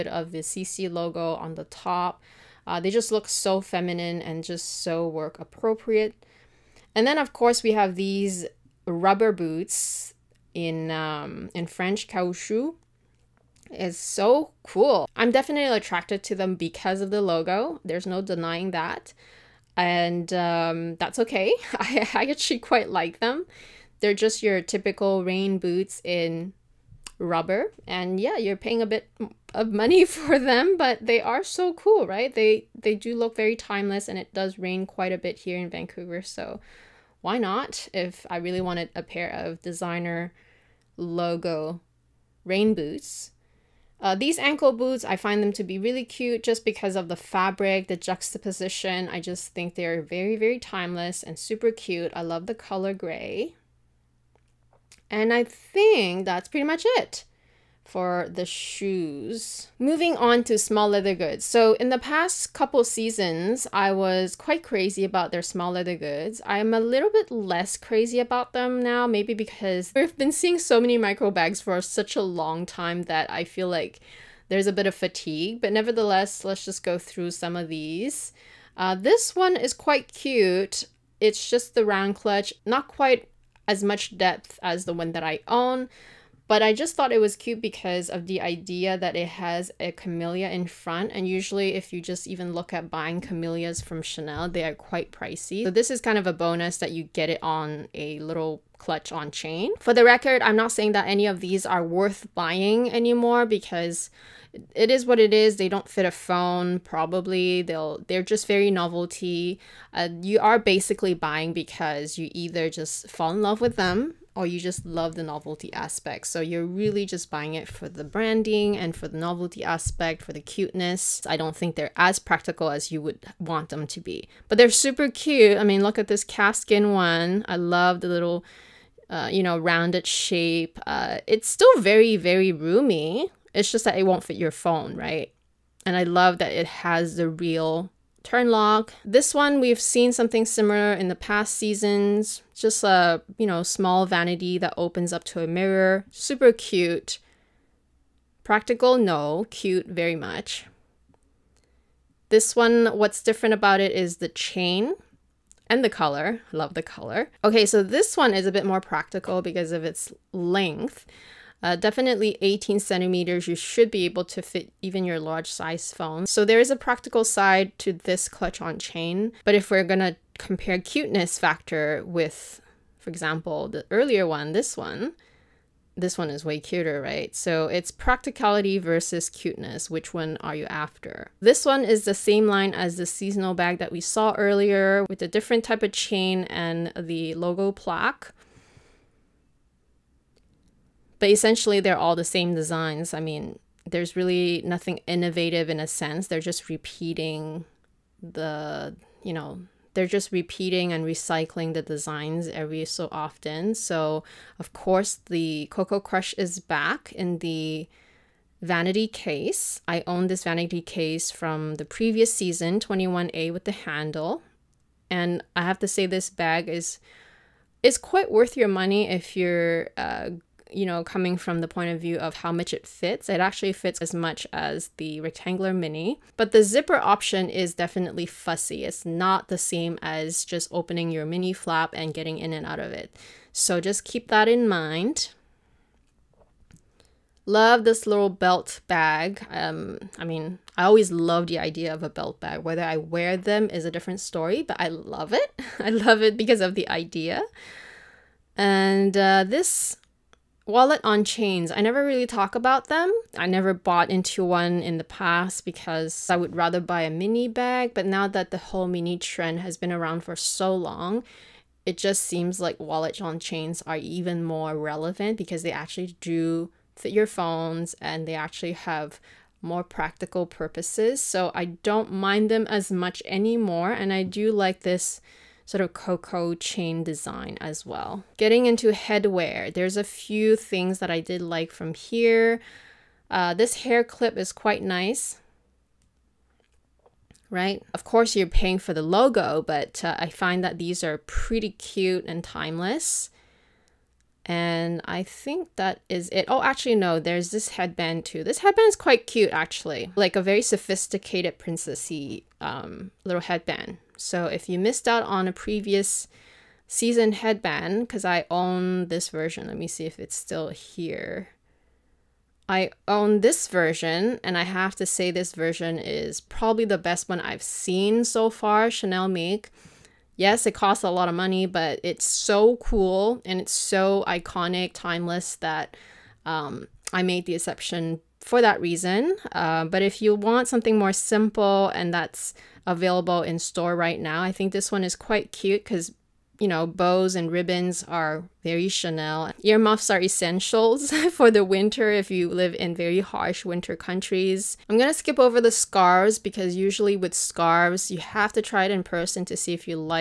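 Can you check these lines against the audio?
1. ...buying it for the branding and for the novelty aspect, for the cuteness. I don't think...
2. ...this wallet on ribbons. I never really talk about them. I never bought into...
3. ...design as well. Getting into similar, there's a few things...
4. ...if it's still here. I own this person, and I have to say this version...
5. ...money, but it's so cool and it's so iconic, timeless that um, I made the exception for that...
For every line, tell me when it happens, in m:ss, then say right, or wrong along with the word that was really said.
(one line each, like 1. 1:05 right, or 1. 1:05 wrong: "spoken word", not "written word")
1. 1:57 right
2. 4:09 wrong: "chains", not "ribbons"
3. 4:37 wrong: "headwear", not "similar"
4. 5:10 wrong: "version", not "person"
5. 5:21 right.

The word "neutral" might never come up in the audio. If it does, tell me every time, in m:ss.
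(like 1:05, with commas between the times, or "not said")
not said.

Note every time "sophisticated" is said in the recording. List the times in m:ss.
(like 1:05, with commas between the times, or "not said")
5:00.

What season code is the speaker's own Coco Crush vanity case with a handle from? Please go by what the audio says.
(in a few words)
21A.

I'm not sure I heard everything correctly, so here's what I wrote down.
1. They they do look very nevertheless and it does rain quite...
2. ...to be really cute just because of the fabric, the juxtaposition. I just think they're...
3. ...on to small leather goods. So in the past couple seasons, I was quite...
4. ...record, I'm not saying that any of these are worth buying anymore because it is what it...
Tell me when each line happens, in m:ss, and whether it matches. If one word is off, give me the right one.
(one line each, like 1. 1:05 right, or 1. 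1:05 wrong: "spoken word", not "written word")
1. 0:32 wrong: "timeless", not "nevertheless"
2. 0:45 right
3. 1:00 right
4. 1:40 right.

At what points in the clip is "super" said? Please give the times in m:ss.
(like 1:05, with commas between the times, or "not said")
0:51, 2:04, 2:26.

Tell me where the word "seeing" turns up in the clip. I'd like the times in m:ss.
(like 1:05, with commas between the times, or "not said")
1:10.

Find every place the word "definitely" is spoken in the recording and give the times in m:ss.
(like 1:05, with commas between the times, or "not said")
0:15, 2:41, 3:47.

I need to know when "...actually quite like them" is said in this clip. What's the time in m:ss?
0:22.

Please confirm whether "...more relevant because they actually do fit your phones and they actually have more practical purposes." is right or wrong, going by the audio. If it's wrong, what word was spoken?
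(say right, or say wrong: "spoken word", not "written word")
right.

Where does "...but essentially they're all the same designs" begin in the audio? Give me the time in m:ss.
3:11.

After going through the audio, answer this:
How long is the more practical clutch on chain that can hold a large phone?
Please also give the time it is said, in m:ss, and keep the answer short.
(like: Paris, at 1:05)
18 centimeters, at 2:42.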